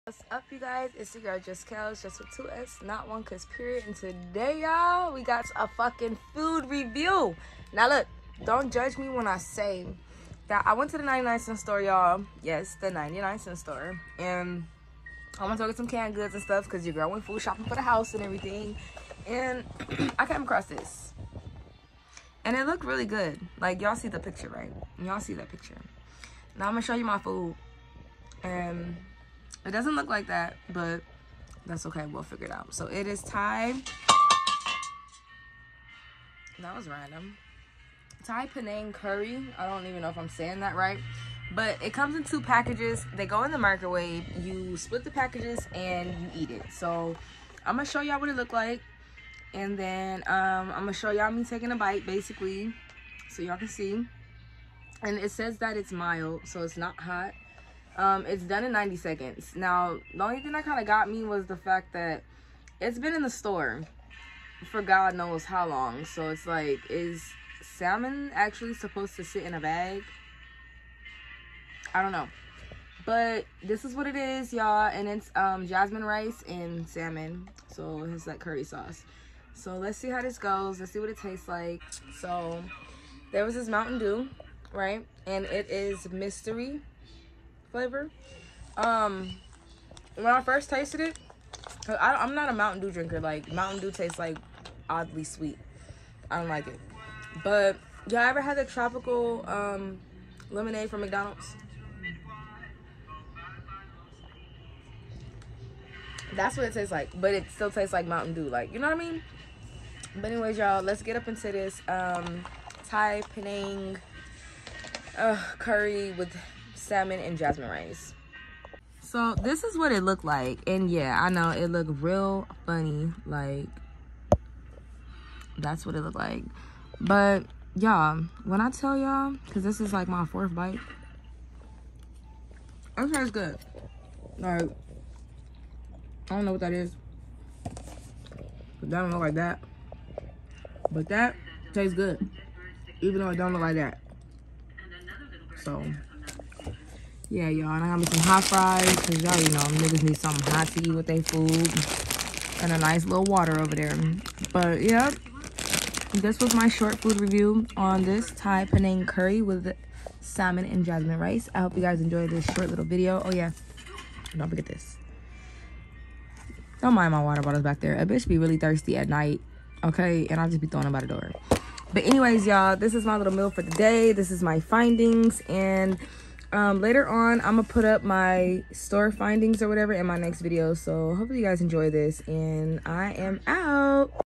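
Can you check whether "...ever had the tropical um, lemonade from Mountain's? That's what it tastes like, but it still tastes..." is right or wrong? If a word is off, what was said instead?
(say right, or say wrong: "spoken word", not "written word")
wrong: "McDonald", not "Mountain".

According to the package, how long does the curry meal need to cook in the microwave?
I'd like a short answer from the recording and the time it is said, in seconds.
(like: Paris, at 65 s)
90 seconds, at 58 s.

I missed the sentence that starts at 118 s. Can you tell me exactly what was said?
So this is what it looked like.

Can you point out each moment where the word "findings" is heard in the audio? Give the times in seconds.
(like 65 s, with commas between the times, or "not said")
174 s, 179 s.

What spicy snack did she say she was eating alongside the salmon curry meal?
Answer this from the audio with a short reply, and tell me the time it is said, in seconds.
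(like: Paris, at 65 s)
Hot fries, at 148 s.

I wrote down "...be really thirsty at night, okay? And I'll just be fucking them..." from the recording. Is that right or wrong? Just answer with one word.
wrong.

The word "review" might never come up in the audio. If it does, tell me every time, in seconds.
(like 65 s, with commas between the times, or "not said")
6 s, 157 s.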